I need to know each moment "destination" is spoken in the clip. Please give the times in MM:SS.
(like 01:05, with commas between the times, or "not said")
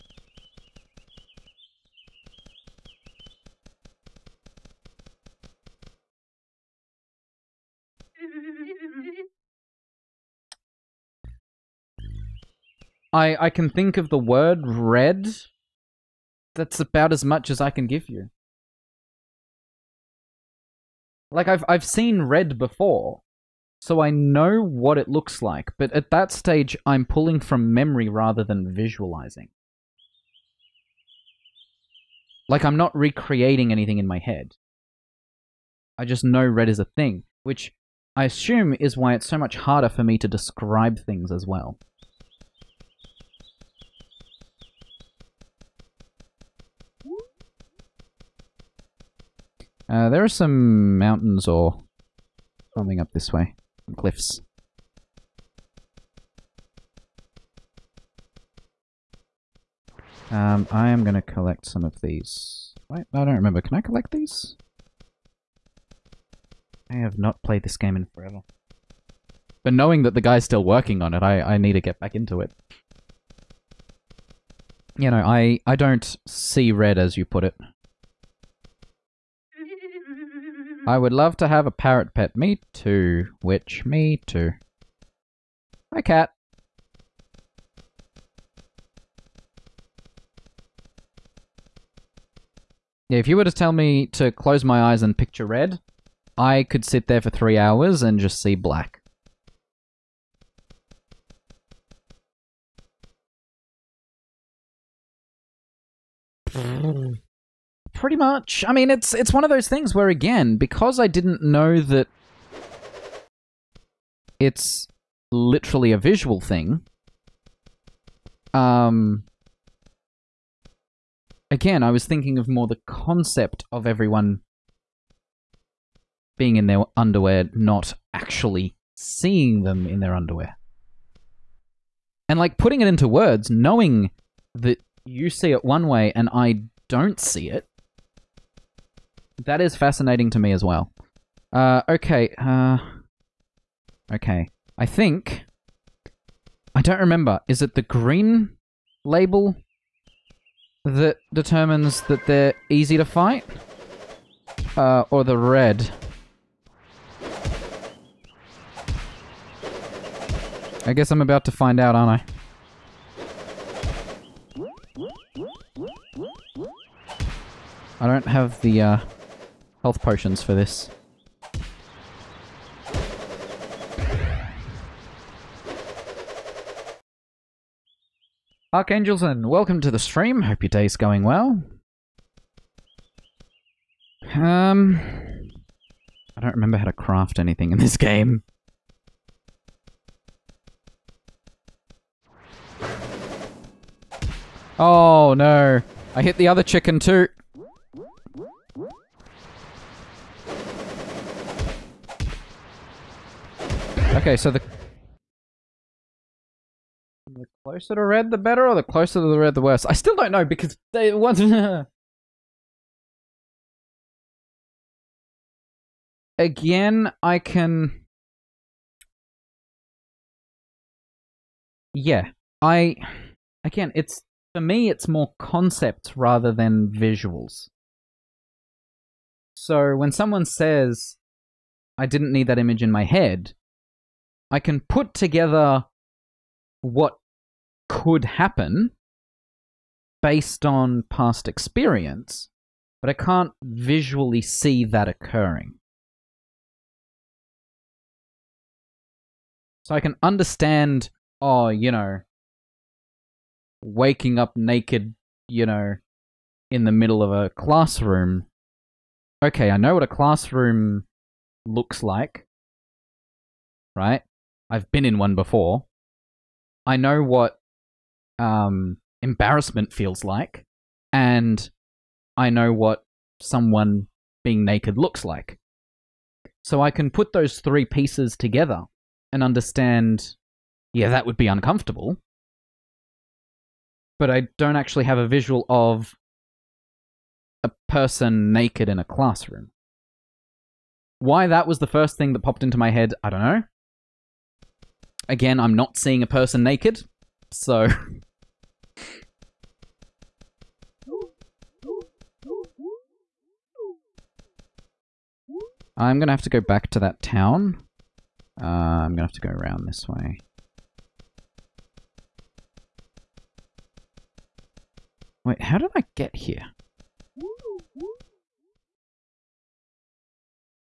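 not said.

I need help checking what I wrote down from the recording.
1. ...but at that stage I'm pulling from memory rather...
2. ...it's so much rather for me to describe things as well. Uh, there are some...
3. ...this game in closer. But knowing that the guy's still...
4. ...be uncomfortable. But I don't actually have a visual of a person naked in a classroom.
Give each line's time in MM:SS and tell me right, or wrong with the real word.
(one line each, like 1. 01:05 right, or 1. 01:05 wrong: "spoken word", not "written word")
1. 00:25 right
2. 00:39 wrong: "harder", not "rather"
3. 01:07 wrong: "forever", not "closer"
4. 04:41 right.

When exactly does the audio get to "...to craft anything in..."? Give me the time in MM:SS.
03:06.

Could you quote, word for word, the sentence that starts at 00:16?
That's about as much as I can give you.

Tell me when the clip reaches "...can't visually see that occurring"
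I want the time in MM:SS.
04:03.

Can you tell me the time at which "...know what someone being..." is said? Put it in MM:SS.
04:32.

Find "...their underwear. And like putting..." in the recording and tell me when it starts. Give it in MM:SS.
02:09.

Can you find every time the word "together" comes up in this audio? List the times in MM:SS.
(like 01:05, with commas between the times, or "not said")
03:55, 04:38.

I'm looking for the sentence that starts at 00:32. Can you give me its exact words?
Like I'm not recreating anything in my head.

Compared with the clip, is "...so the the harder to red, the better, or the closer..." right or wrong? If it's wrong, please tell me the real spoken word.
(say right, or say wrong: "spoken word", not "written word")
wrong: "closer", not "harder".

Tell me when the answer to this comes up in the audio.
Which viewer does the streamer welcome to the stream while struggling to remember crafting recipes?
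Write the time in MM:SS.
02:58.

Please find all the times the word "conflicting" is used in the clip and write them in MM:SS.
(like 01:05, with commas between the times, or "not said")
not said.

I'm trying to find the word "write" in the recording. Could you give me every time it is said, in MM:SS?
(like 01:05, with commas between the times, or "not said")
not said.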